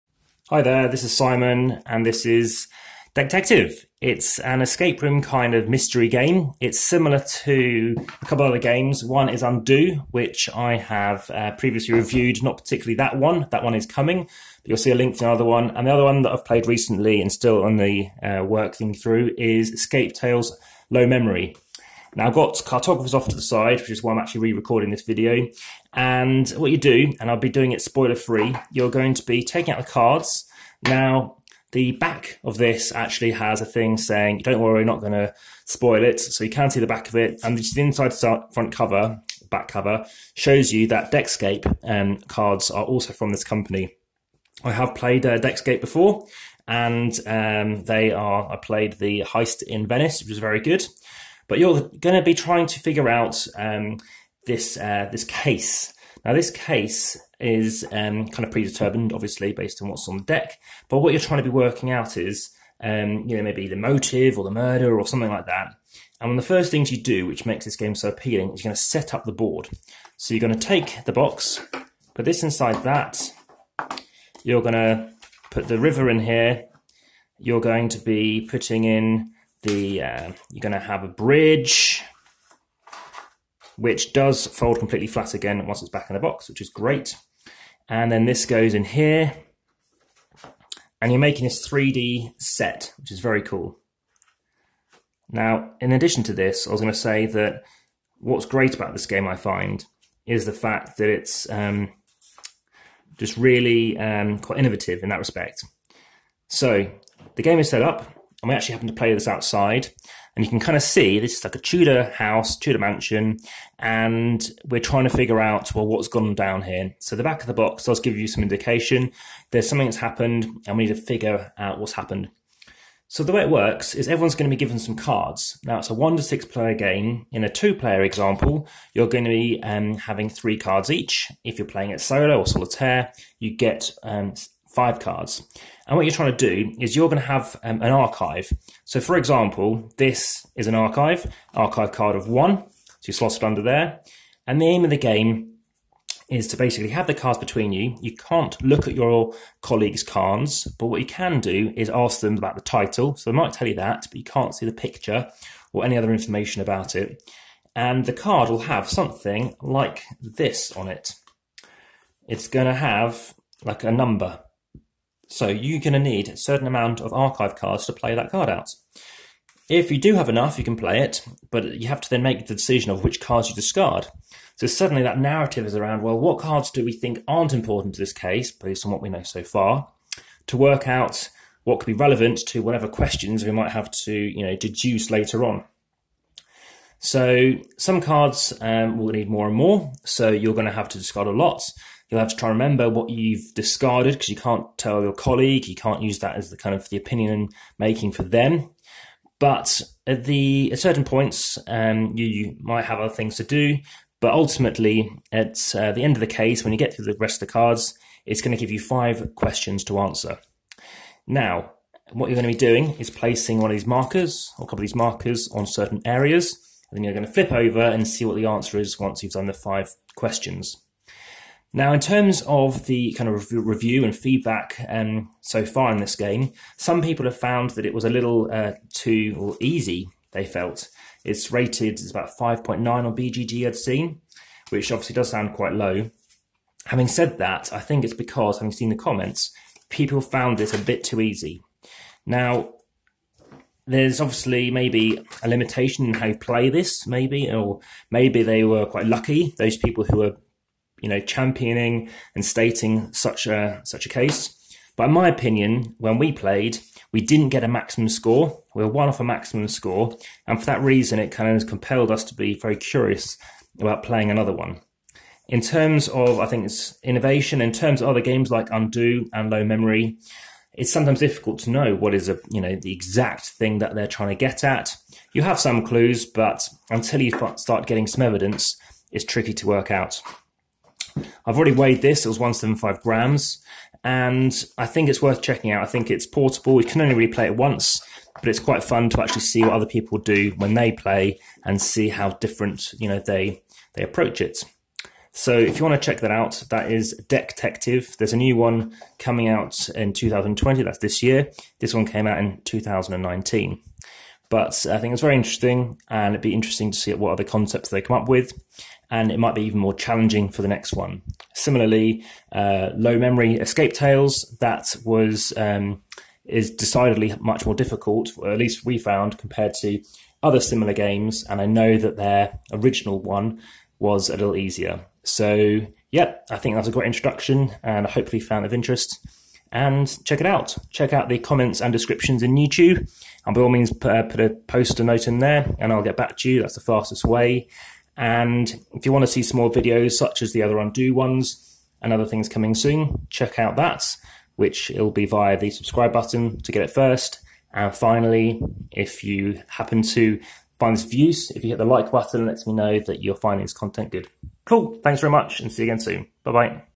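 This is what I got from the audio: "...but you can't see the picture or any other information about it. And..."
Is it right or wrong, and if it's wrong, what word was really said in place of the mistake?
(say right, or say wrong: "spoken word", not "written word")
right.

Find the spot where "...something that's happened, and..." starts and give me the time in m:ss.
1:59.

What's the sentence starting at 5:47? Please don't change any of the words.
And finally, if you happen to finds views.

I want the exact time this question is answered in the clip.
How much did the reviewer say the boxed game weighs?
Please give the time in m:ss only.
4:42.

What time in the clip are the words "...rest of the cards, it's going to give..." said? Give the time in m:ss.
3:27.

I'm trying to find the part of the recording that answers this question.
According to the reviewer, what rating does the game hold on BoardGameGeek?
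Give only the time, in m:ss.
3:52.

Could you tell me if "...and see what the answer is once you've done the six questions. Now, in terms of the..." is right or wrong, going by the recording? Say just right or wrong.
wrong.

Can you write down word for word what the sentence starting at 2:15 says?
And what you're trying to do is you're going to have um, an archive.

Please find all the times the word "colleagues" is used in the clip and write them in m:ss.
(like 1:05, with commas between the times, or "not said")
2:29, 3:15.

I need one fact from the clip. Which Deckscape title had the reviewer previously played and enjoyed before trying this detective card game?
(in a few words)
Heist in Venice.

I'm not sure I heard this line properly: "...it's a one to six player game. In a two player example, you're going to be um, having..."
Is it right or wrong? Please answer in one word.
right.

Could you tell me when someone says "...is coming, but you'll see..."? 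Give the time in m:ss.
0:13.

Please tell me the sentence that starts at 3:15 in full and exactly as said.
You can't use that as the kind of the opinion making for them.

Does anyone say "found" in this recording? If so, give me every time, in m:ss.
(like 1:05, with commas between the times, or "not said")
3:47, 4:00, 5:18, 5:28.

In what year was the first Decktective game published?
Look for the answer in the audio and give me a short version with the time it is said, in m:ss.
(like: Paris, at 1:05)
2019, at 5:02.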